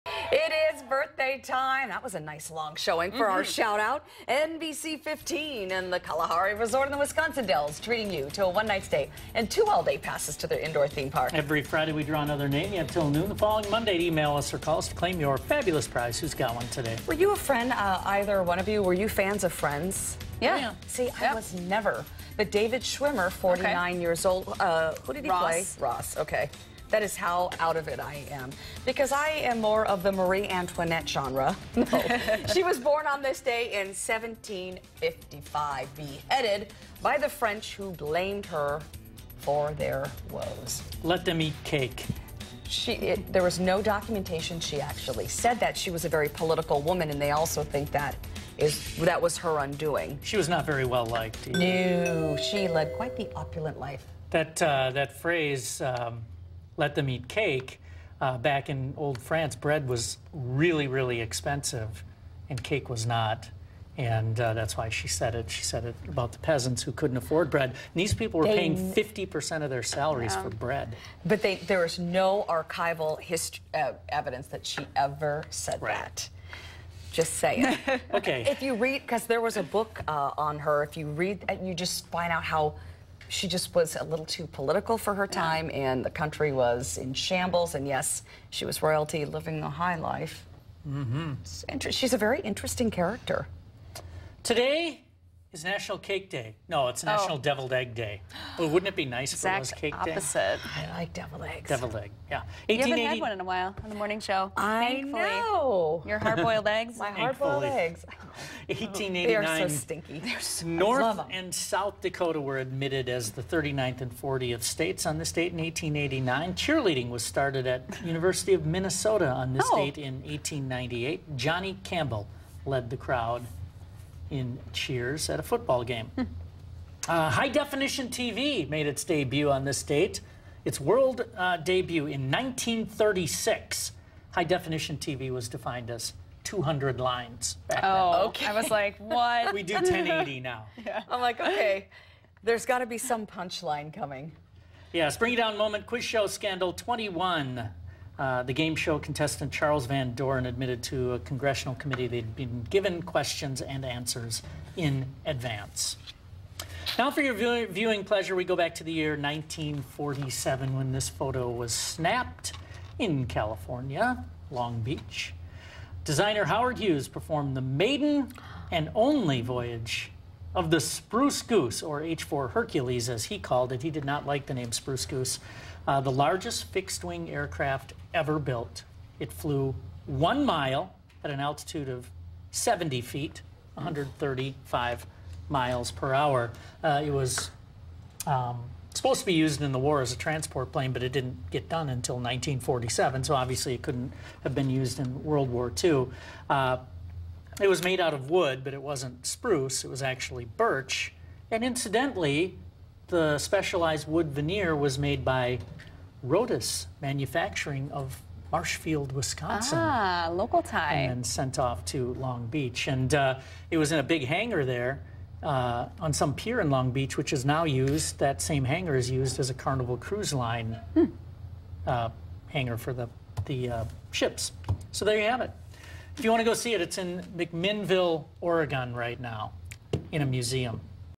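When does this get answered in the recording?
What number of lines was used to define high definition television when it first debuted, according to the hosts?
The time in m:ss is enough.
2:16.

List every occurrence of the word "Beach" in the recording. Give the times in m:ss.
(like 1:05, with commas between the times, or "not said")
2:44, 3:32, 3:36.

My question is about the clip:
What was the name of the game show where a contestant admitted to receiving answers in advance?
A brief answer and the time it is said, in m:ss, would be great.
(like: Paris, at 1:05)
21, at 2:26.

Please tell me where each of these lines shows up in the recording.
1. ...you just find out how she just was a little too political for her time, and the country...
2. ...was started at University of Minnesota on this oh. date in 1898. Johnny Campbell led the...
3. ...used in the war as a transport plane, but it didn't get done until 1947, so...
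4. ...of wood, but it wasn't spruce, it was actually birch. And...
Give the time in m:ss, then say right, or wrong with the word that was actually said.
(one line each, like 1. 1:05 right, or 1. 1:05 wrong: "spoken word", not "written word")
1. 1:21 right
2. 1:57 right
3. 3:09 right
4. 3:18 right.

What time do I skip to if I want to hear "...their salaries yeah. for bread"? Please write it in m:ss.
1:09.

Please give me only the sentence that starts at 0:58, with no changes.
Uh, back in old France, bread was really, really expensive, and cake was not.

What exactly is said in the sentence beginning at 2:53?
He did not like the name Spruce Goose.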